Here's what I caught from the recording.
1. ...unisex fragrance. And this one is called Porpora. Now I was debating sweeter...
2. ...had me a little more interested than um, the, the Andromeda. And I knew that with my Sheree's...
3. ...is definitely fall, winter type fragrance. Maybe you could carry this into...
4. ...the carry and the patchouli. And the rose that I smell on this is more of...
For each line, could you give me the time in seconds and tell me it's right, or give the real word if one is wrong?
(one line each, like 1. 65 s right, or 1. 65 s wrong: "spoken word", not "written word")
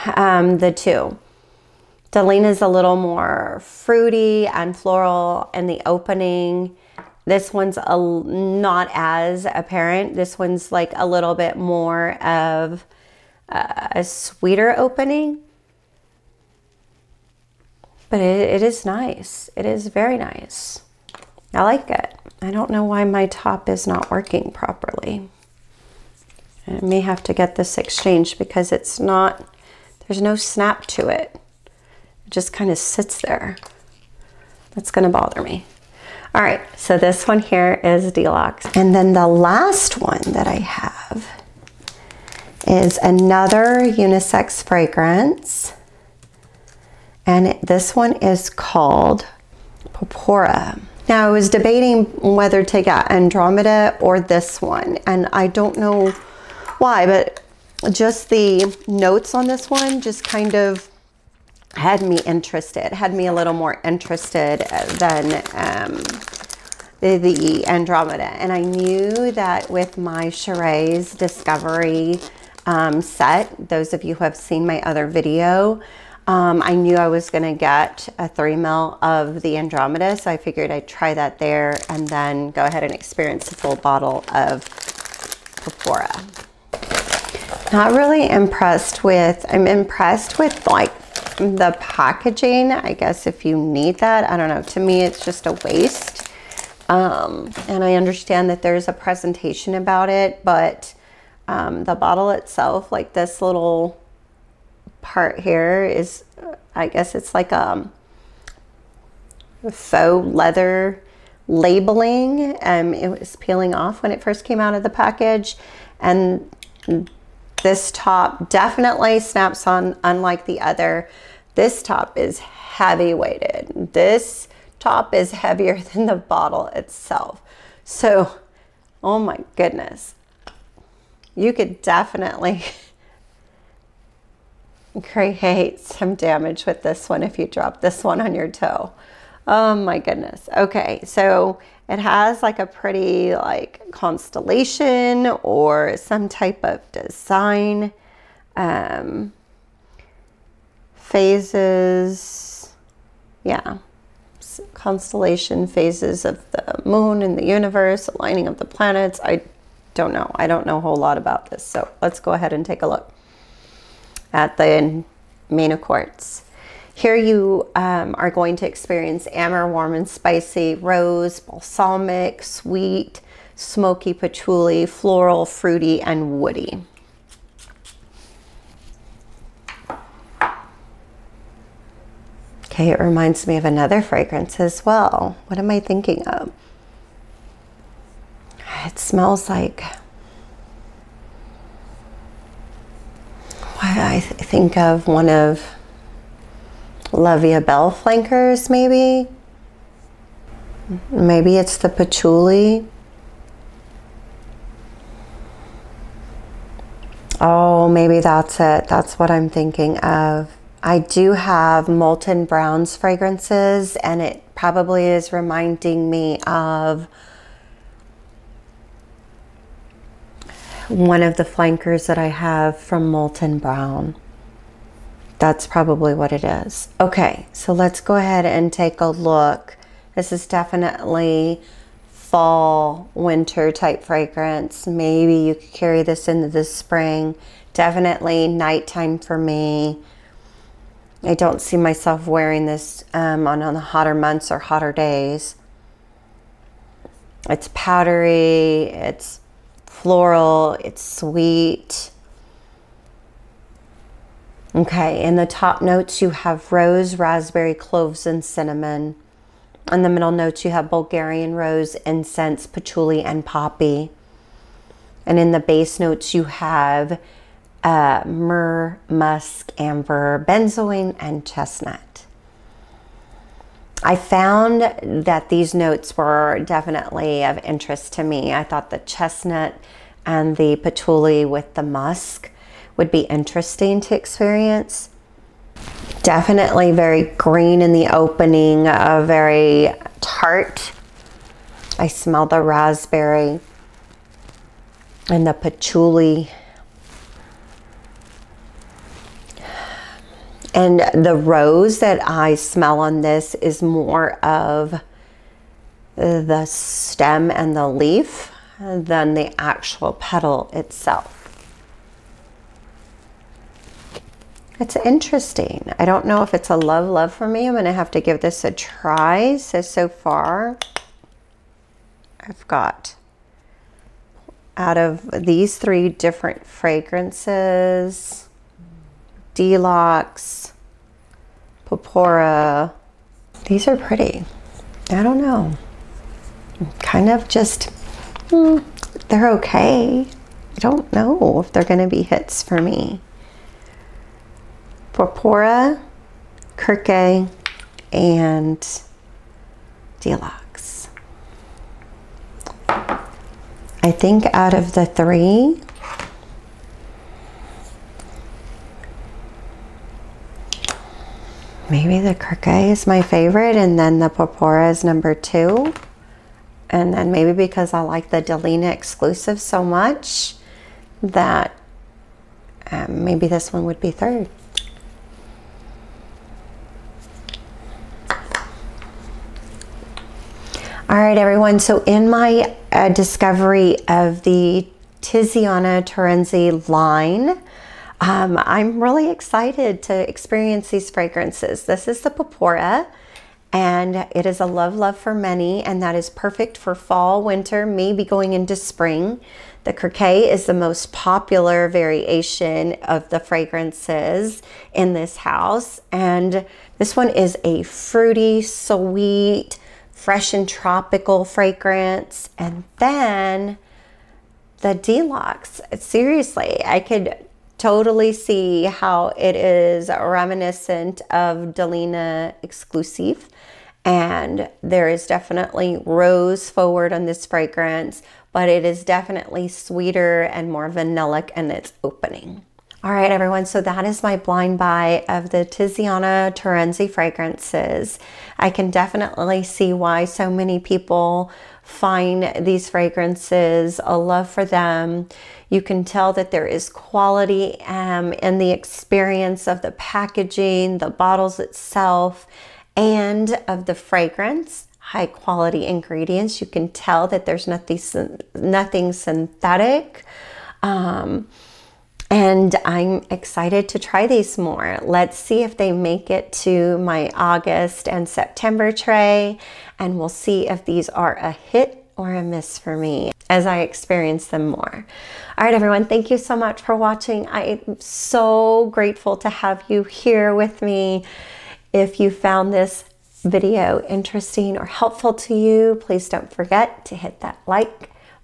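1. 43 s wrong: "whether", not "sweeter"
2. 62 s right
3. 230 s right
4. 292 s wrong: "raspberry", not "carry".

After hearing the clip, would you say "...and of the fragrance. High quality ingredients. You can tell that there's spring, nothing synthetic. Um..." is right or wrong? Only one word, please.
wrong.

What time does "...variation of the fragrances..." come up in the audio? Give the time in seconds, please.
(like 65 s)
401 s.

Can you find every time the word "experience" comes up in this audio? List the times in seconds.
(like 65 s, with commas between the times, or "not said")
82 s, 168 s, 284 s, 390 s, 448 s, 473 s.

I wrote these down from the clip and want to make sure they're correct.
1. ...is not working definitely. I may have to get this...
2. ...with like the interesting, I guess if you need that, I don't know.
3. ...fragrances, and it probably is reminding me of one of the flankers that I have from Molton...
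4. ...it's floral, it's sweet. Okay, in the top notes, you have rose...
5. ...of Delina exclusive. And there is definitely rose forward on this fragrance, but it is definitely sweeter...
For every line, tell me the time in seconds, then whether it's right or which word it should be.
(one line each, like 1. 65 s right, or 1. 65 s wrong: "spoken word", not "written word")
1. 23 s wrong: "properly", not "definitely"
2. 90 s wrong: "packaging", not "interesting"
3. 212 s right
4. 248 s right
5. 421 s right.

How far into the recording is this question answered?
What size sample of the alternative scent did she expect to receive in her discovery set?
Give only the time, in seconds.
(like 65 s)
78 s.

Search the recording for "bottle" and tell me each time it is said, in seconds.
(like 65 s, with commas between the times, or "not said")
83 s, 101 s, 126 s, 451 s.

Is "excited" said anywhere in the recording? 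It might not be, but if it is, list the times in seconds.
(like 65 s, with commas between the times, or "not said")
389 s, 463 s.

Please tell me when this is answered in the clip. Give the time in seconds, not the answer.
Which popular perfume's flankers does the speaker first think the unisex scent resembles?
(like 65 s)
197 s.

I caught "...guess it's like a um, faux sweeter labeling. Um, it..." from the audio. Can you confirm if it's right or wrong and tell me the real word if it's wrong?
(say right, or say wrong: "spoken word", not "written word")
wrong: "leather", not "sweeter".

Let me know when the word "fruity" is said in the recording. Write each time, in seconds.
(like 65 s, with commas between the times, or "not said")
3 s, 175 s, 407 s.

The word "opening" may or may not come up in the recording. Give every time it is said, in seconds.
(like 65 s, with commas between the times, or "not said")
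5 s, 14 s, 288 s, 432 s.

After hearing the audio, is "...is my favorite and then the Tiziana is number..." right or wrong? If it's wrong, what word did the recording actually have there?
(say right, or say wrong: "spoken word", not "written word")
wrong: "Porpora", not "Tiziana".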